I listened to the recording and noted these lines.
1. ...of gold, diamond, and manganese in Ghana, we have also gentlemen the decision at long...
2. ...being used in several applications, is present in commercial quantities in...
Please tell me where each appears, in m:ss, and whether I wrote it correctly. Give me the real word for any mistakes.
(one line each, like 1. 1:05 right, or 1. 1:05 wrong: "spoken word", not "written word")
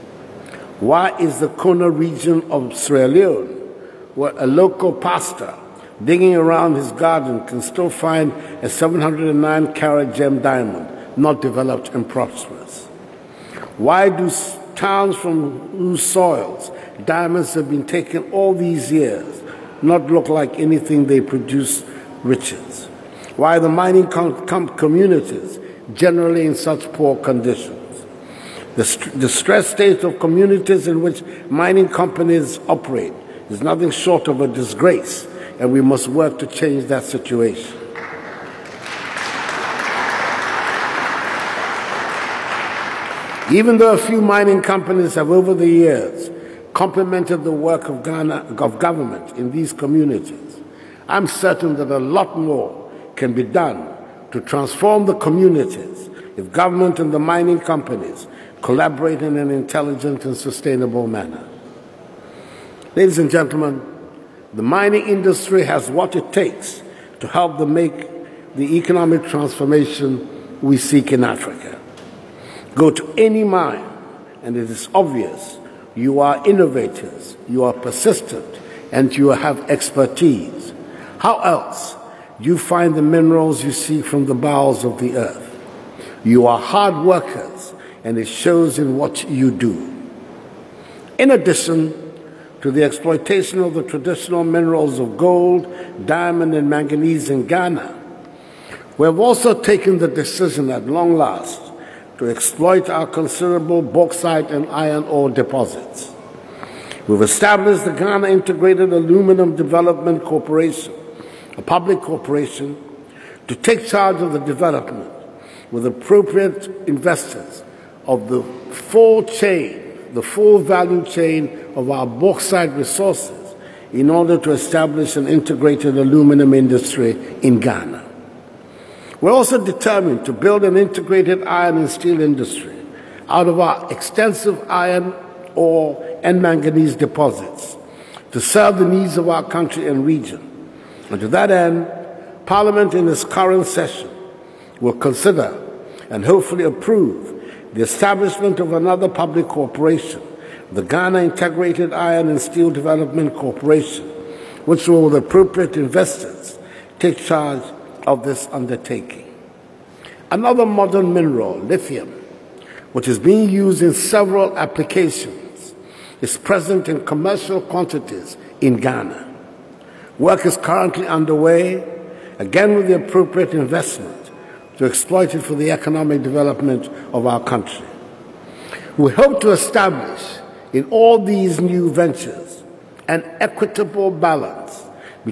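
1. 1:34 wrong: "taken", not "gentlemen"
2. 2:43 right.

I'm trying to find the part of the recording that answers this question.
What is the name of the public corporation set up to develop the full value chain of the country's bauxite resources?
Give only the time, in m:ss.
1:47.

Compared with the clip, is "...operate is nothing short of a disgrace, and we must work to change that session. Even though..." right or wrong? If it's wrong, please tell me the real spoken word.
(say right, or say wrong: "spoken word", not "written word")
wrong: "situation", not "session".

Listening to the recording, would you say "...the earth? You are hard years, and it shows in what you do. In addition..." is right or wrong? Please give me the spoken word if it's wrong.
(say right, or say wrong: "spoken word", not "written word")
wrong: "workers", not "years".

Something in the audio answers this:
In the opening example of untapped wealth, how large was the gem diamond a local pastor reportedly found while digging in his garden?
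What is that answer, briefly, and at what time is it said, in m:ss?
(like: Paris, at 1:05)
709 carats, at 0:08.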